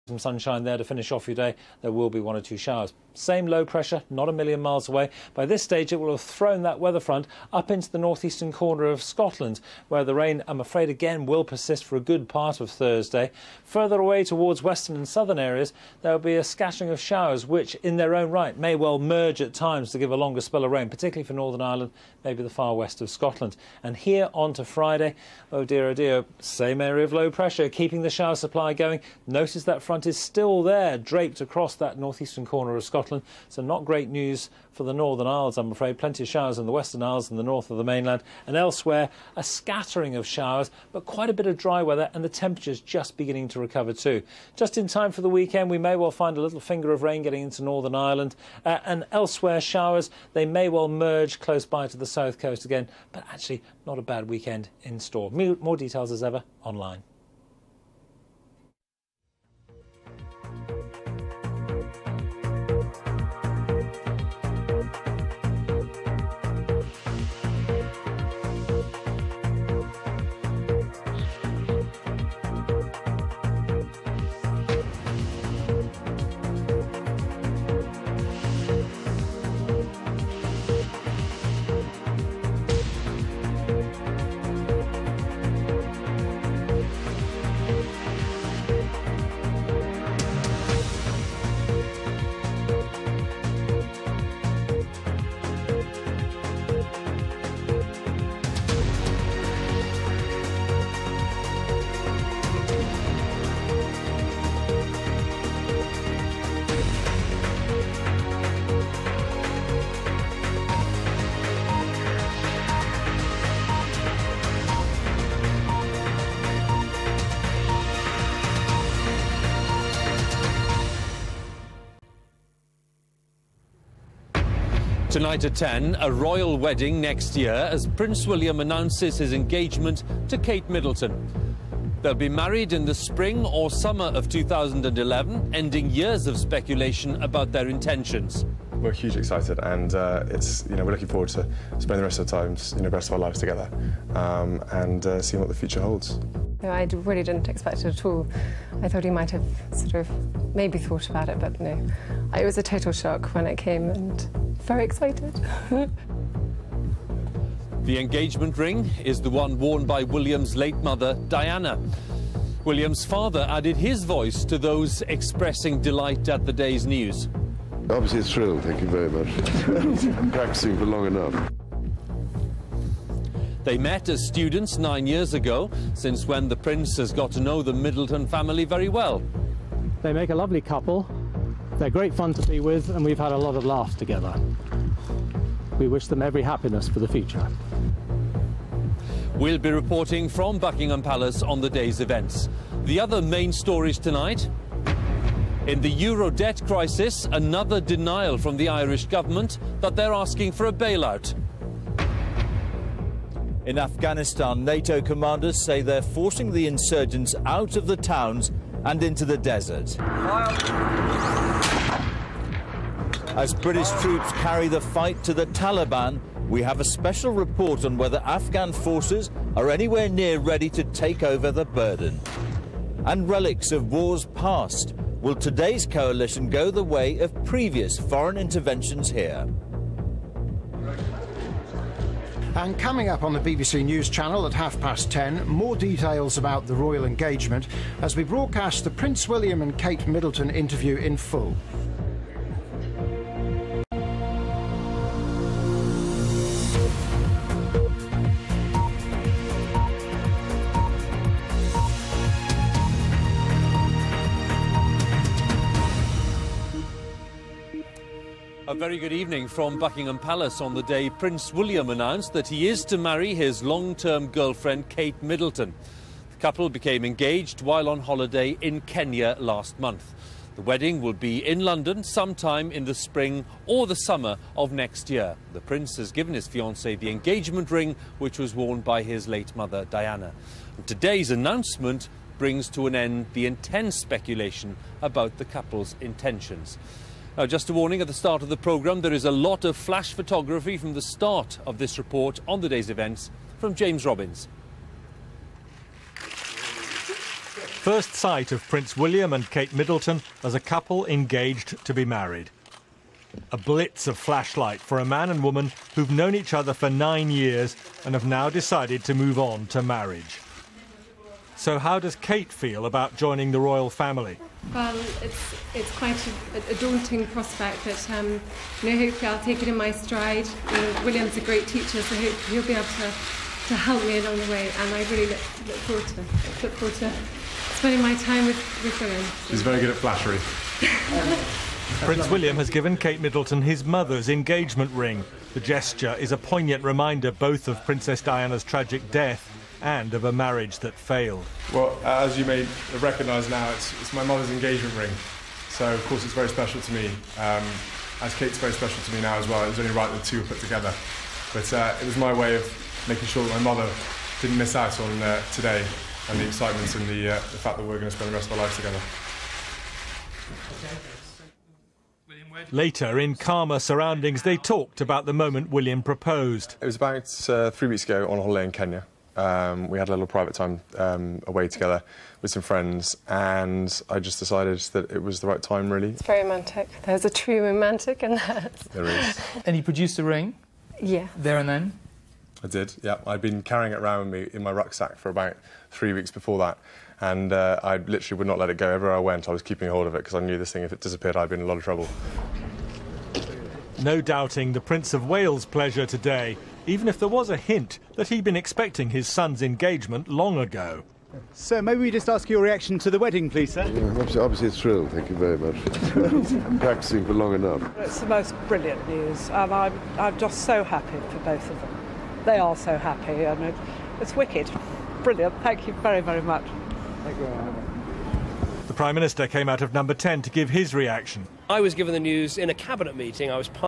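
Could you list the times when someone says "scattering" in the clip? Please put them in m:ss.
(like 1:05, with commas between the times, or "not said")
0:16, 0:39.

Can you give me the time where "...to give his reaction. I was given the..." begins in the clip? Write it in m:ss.
7:00.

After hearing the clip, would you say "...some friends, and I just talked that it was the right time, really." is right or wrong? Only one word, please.
wrong.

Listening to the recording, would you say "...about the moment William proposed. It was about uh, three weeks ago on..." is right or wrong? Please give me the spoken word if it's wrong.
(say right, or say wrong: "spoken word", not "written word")
right.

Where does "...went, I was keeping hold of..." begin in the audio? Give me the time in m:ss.
6:29.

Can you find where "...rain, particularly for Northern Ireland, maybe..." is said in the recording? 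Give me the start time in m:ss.
0:20.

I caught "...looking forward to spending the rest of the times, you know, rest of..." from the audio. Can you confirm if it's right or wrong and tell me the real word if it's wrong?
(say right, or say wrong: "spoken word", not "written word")
right.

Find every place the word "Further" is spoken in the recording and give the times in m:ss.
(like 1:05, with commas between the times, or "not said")
0:13.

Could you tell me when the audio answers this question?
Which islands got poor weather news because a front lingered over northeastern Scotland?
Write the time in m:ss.
0:34.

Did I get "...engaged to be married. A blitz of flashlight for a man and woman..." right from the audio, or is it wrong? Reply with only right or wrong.
right.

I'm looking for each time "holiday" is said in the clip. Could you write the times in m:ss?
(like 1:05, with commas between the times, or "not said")
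4:27, 6:08.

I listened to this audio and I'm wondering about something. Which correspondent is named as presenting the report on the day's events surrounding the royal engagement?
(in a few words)
James Robbins.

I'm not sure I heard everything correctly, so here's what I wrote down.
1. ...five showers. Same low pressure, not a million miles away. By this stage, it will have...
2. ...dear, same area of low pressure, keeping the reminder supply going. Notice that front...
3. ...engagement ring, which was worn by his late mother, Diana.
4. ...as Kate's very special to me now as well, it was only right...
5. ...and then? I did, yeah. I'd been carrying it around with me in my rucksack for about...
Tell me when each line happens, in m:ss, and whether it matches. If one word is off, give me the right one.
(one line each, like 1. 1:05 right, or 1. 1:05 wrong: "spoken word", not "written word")
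1. 0:02 wrong: "two", not "five"
2. 0:25 wrong: "shower", not "reminder"
3. 4:37 right
4. 5:48 right
5. 6:21 right.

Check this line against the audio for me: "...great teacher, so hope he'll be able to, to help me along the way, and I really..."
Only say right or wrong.
right.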